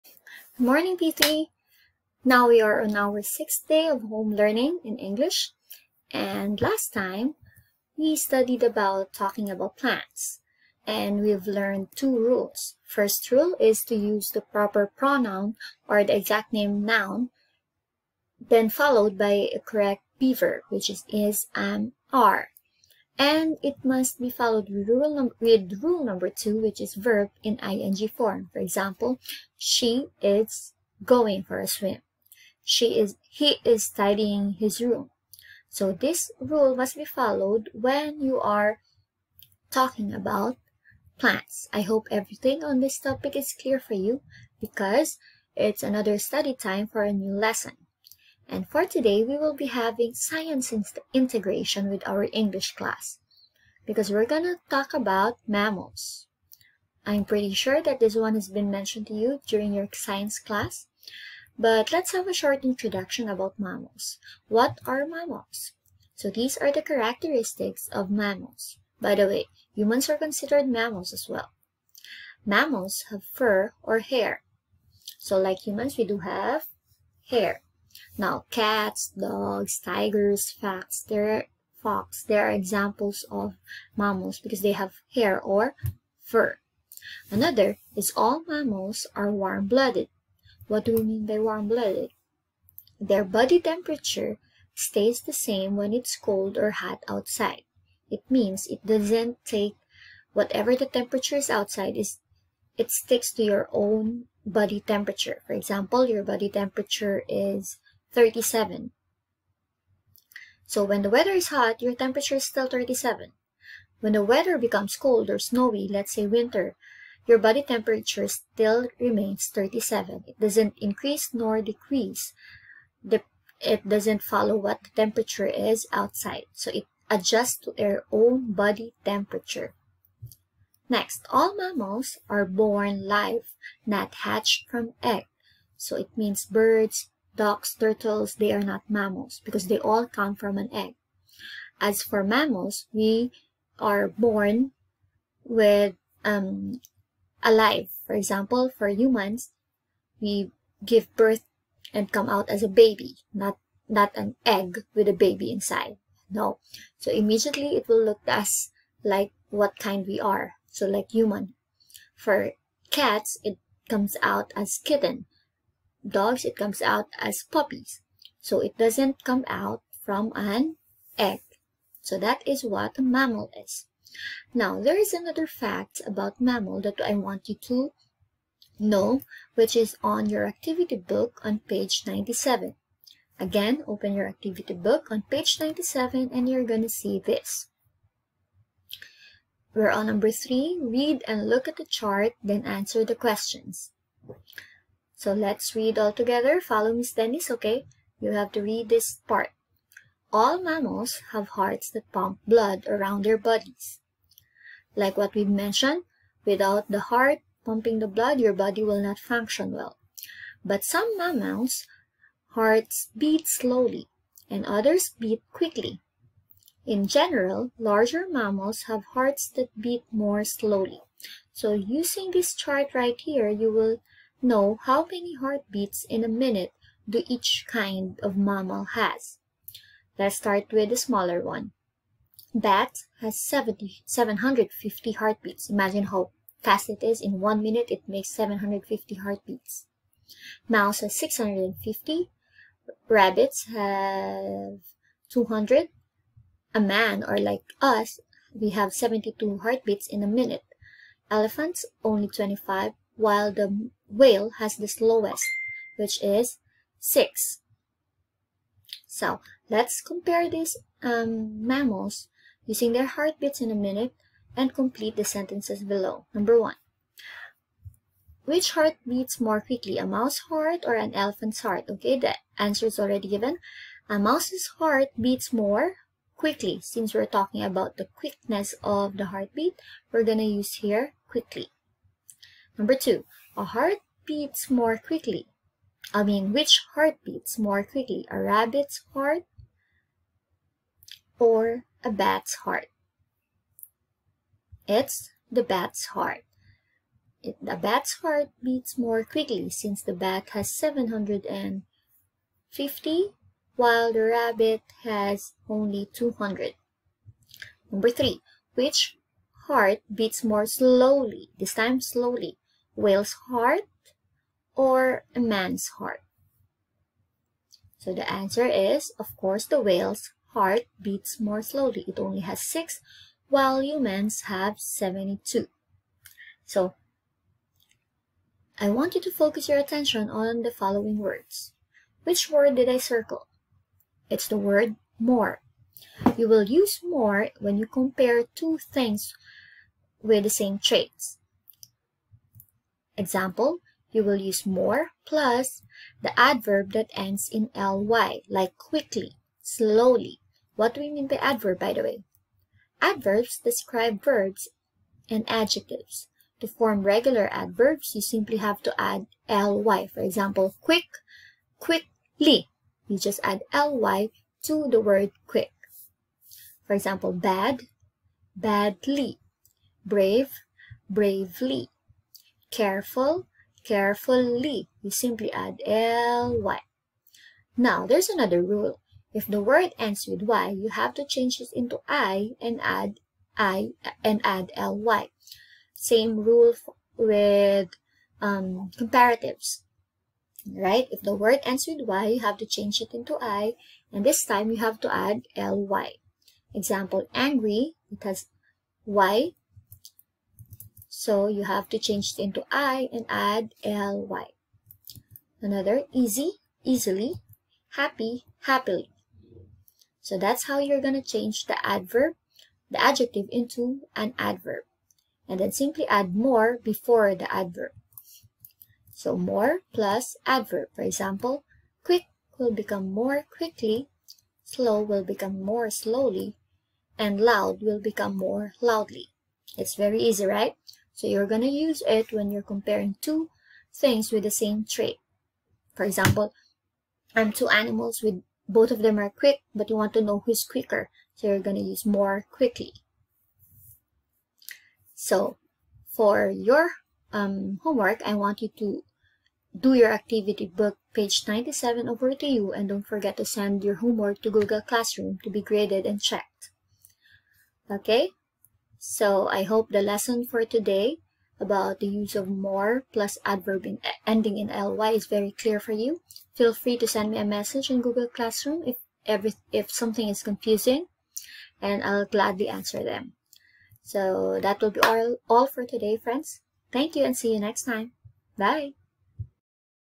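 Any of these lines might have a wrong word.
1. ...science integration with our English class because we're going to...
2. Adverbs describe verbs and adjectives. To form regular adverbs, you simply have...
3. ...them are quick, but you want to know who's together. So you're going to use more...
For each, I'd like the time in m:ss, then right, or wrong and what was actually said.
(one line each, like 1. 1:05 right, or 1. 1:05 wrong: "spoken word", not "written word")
1. 0:50 right
2. 5:53 right
3. 7:18 wrong: "quicker", not "together".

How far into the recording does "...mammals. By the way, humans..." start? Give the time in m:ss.
1:08.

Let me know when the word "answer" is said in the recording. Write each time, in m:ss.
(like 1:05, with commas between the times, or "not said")
3:12, 4:32, 5:18, 7:52.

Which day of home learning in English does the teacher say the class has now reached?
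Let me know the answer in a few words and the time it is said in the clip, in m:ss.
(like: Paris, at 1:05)
sixth, at 0:03.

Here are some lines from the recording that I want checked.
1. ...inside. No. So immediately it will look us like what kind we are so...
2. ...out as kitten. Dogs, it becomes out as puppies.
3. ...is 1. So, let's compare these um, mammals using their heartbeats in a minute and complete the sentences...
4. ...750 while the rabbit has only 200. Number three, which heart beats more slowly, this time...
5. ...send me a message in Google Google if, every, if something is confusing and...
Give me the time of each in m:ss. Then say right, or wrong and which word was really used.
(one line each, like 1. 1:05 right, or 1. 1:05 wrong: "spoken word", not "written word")
1. 2:35 right
2. 2:44 wrong: "comes", not "becomes"
3. 4:16 wrong: "6", not "1"
4. 5:00 right
5. 7:47 wrong: "Classroom", not "Google".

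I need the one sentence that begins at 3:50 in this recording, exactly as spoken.
Let's start with the smaller one.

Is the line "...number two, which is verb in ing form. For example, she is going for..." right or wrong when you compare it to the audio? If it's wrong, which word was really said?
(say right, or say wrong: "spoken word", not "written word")
right.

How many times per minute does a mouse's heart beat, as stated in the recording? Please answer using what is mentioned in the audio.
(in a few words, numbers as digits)
650.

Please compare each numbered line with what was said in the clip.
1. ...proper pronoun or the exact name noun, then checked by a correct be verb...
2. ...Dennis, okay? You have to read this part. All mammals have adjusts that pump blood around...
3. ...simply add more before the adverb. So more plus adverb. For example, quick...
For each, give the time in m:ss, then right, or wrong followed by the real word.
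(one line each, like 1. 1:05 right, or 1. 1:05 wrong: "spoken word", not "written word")
1. 0:14 wrong: "followed", not "checked"
2. 3:17 wrong: "hearts", not "adjusts"
3. 6:55 right.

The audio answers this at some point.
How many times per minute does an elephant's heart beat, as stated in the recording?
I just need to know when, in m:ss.
4:12.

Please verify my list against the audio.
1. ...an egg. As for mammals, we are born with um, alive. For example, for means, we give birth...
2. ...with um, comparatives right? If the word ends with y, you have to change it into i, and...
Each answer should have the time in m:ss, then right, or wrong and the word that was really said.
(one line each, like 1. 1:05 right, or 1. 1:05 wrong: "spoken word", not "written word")
1. 2:20 wrong: "humans", not "means"
2. 6:27 right.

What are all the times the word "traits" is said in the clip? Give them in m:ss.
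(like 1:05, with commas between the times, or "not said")
5:40, 7:14.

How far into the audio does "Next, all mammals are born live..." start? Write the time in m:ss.
2:10.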